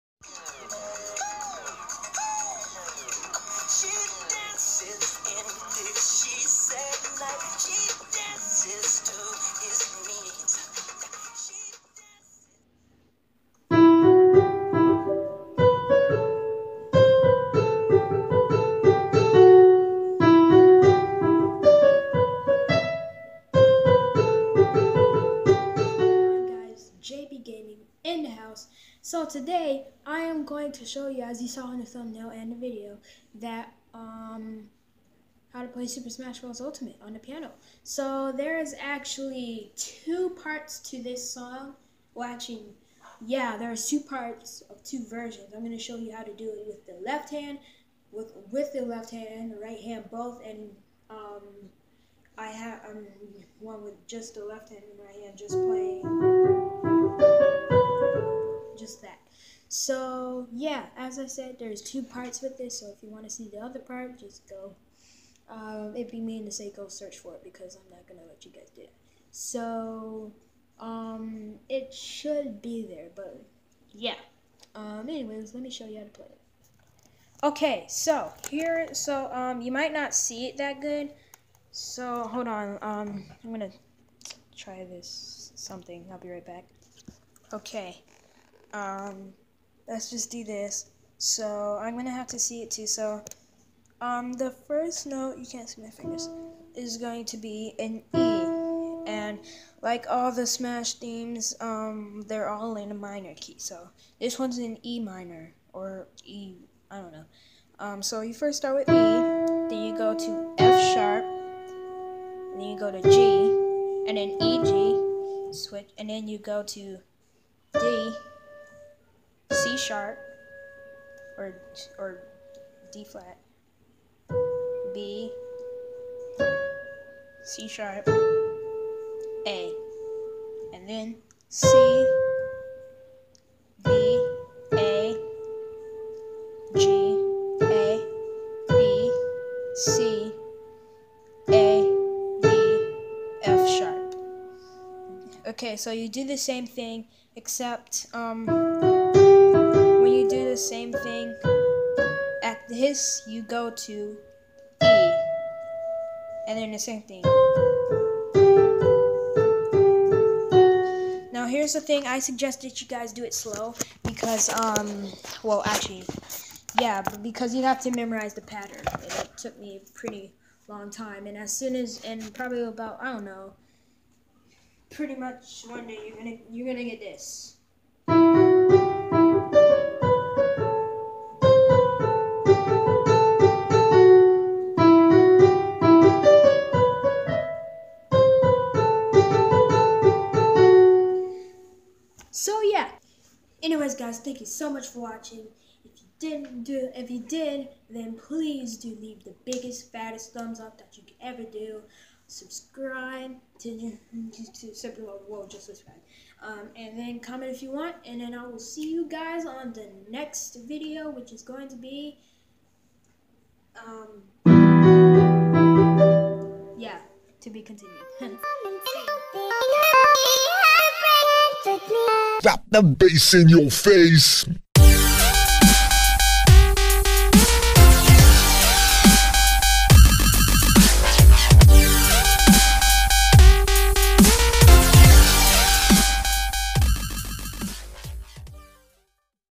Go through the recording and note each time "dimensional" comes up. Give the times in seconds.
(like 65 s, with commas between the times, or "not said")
not said.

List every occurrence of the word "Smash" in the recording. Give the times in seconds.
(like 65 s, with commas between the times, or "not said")
36 s, 100 s.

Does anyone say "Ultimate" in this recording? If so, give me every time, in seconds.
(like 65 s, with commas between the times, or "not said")
36 s.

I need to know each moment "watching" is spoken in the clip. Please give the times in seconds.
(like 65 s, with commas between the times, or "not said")
195 s.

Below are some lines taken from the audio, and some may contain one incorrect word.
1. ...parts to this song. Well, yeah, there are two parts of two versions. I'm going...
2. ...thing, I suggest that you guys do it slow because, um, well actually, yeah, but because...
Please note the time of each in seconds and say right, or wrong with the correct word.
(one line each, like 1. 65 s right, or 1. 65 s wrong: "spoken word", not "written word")
1. 40 s right
2. 161 s right.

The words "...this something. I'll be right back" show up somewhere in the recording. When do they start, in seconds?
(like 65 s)
84 s.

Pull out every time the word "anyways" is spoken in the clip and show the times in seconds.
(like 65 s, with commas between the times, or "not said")
75 s, 193 s.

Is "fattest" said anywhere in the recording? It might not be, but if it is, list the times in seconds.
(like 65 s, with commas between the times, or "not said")
199 s.